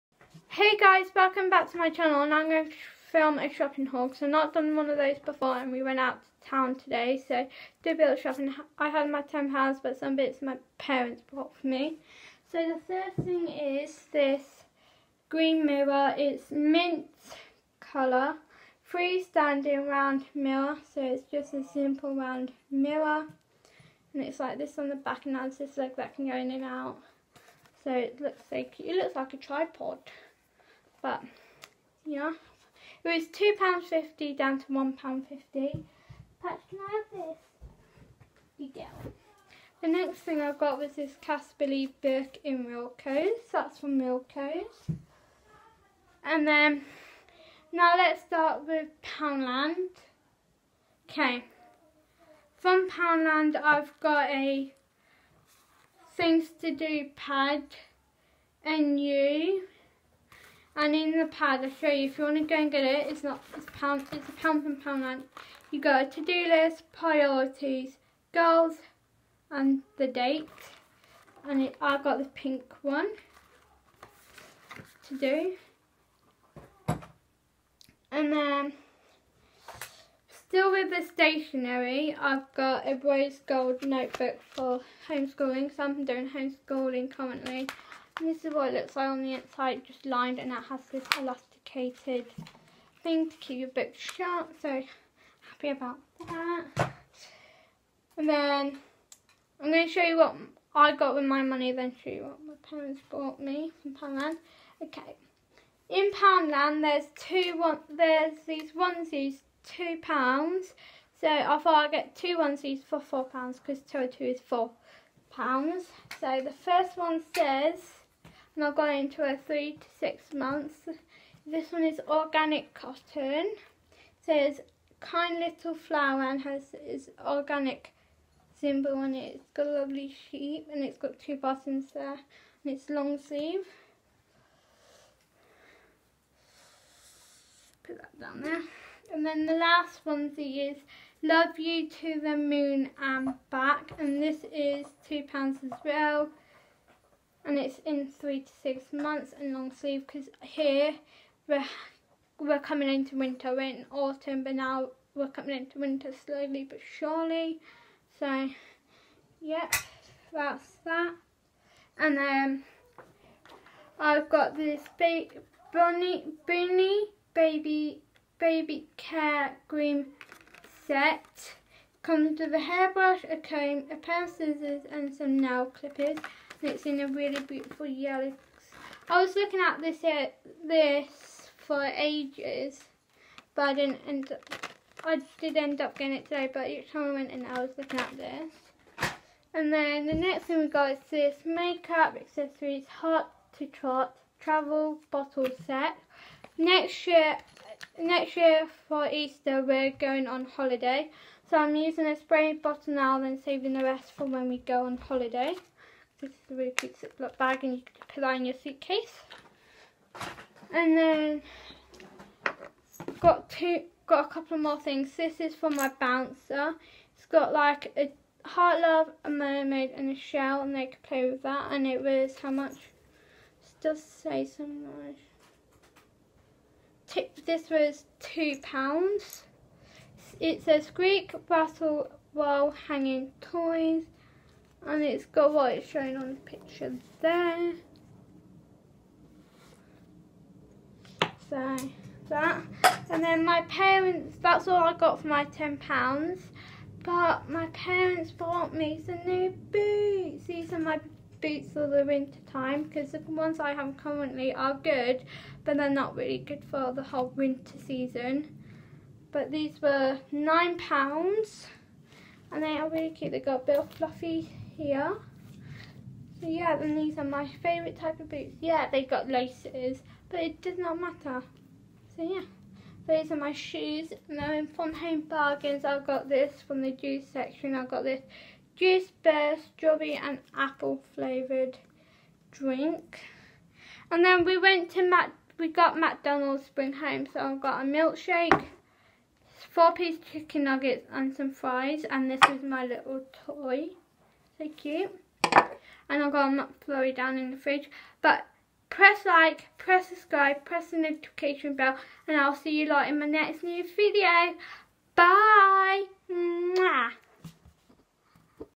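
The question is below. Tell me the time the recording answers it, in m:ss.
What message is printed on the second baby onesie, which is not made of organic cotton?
2:21.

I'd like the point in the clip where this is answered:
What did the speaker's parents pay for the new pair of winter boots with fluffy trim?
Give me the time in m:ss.
4:20.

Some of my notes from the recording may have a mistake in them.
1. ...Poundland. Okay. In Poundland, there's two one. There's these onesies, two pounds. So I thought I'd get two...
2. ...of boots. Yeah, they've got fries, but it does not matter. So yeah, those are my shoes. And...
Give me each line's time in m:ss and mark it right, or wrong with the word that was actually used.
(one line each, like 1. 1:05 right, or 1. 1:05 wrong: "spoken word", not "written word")
1. 1:43 right
2. 4:28 wrong: "laces", not "fries".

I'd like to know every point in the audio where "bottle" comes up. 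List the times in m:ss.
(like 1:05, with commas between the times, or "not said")
3:15, 3:22.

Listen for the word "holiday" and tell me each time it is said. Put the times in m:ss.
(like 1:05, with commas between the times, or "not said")
3:20, 3:24.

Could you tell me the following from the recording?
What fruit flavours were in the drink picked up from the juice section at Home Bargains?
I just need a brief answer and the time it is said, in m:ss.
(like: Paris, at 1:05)
strawberry and apple, at 4:39.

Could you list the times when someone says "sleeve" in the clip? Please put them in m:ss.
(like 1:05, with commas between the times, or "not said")
2:13, 2:29.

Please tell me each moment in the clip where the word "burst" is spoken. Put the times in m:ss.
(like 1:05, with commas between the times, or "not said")
4:39.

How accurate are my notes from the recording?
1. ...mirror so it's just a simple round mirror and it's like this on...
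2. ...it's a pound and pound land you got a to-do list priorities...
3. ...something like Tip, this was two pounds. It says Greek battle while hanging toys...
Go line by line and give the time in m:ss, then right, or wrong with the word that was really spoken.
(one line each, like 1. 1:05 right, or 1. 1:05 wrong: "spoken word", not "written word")
1. 0:20 right
2. 1:04 right
3. 3:44 right.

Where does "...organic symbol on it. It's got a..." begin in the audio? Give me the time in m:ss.
2:07.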